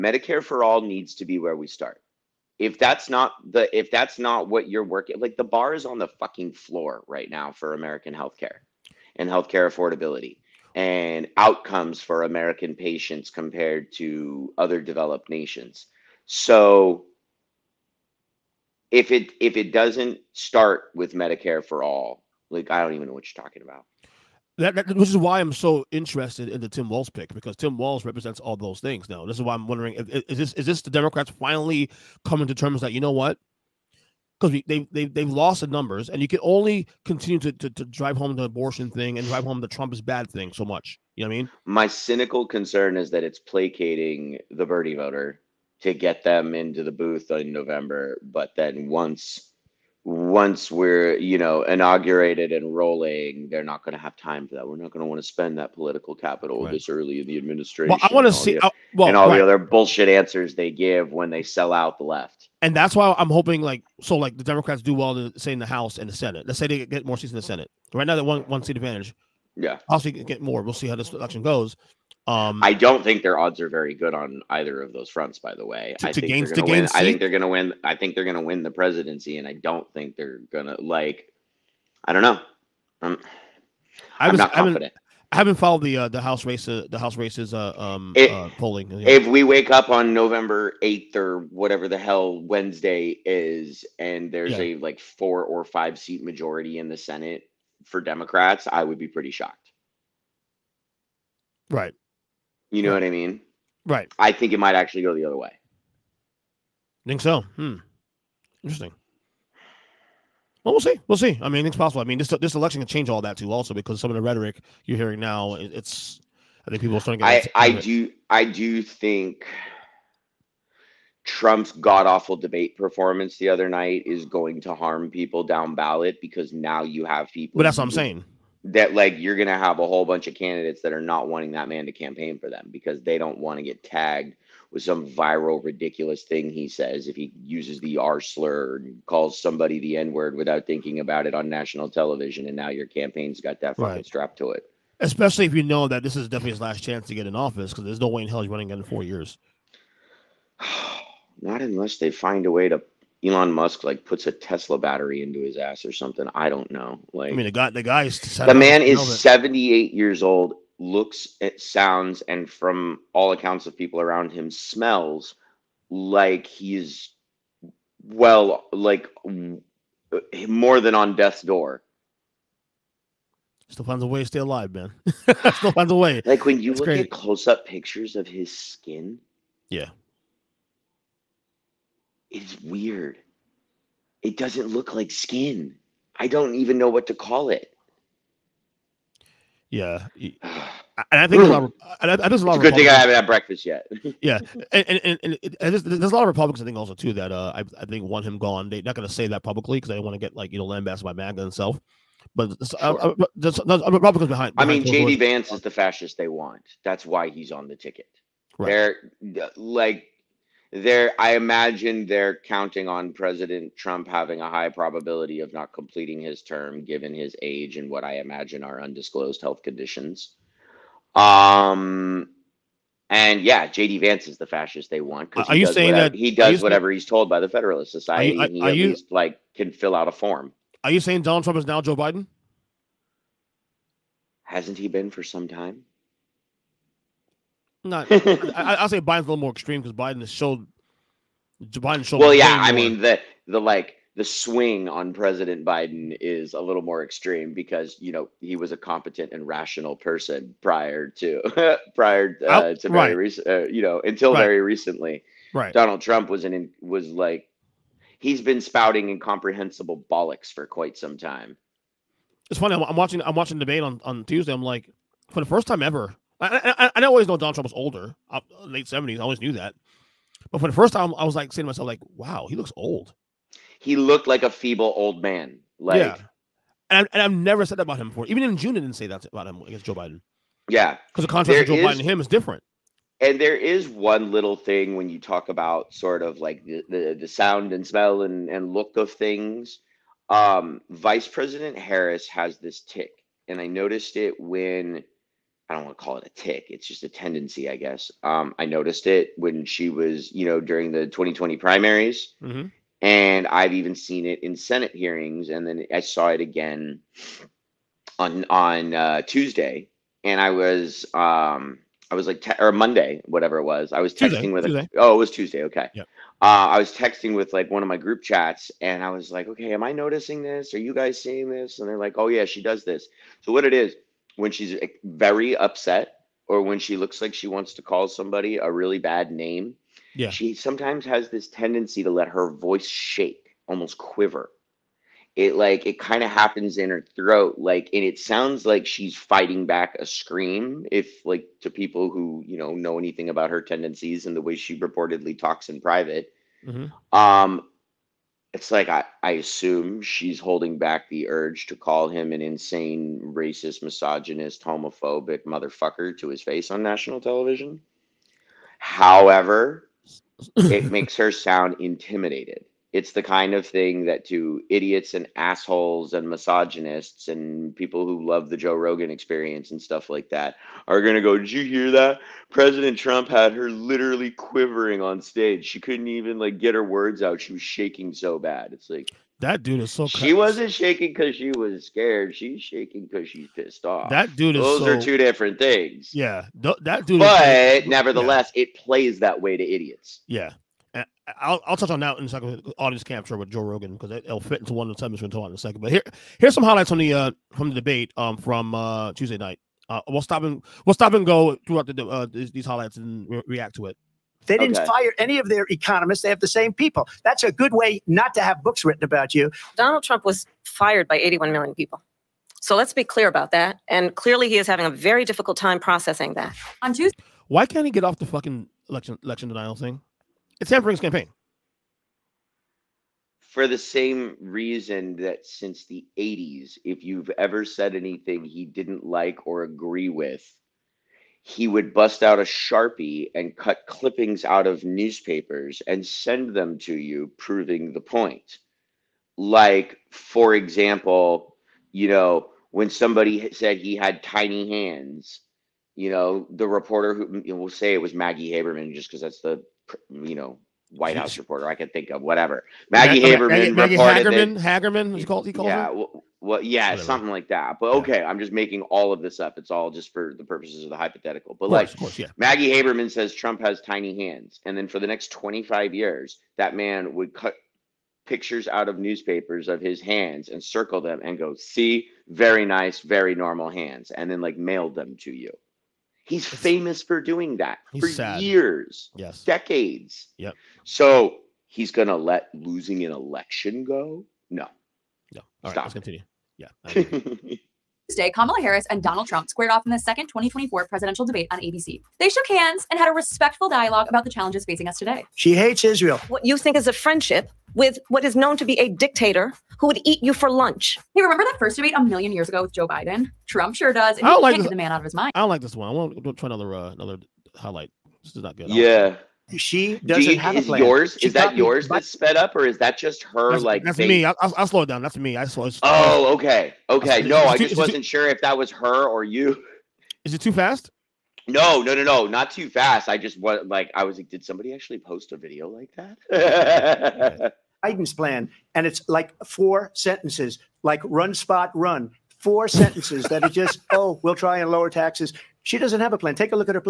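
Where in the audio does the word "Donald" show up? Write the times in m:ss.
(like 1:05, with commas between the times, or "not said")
3:51, 4:15, 4:27, 6:49, 8:09.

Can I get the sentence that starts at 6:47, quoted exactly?
That's a good way not to have books written about you.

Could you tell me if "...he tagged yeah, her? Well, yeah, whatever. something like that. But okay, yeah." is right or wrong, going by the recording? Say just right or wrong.
wrong.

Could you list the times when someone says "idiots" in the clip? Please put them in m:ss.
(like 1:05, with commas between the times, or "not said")
6:04, 6:29.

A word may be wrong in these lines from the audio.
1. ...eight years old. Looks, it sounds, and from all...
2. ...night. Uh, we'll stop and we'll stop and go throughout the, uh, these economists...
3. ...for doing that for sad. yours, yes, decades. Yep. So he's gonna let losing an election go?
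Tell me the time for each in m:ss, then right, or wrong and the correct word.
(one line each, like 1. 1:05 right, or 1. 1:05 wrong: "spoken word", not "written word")
1. 2:39 right
2. 6:39 wrong: "highlights", not "economists"
3. 7:57 wrong: "years", not "yours".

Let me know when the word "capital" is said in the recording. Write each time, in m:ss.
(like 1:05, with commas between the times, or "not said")
0:56.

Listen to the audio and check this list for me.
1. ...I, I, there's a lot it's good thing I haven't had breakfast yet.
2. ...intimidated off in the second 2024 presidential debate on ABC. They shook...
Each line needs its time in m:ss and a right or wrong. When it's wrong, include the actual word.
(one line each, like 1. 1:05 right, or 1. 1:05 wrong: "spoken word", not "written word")
1. 3:12 right
2. 8:09 wrong: "squared", not "intimidated".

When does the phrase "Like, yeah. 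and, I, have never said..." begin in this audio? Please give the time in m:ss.
4:35.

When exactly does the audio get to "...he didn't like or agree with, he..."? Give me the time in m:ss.
7:08.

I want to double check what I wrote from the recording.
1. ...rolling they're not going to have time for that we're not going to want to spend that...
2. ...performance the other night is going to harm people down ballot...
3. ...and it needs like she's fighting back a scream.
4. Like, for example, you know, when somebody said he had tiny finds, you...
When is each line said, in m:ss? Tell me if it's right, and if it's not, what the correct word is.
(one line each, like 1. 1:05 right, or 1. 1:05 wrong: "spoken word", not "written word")
1. 0:52 right
2. 2:02 right
3. 5:37 wrong: "sounds", not "needs"
4. 7:19 wrong: "hands", not "finds".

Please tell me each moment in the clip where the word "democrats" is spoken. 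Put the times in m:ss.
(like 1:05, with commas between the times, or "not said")
0:30, 1:04, 1:37.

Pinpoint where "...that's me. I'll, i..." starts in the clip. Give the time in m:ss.
8:33.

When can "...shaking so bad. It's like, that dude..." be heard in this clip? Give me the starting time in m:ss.
6:17.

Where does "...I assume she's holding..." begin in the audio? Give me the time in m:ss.
5:49.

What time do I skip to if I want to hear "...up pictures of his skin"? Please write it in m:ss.
2:57.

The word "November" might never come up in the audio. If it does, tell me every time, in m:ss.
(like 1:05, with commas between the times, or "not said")
0:47, 1:30.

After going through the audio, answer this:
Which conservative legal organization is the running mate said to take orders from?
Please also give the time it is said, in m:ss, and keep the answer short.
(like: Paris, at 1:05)
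Federalist Society, at 3:47.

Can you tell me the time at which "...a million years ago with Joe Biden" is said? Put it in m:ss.
8:21.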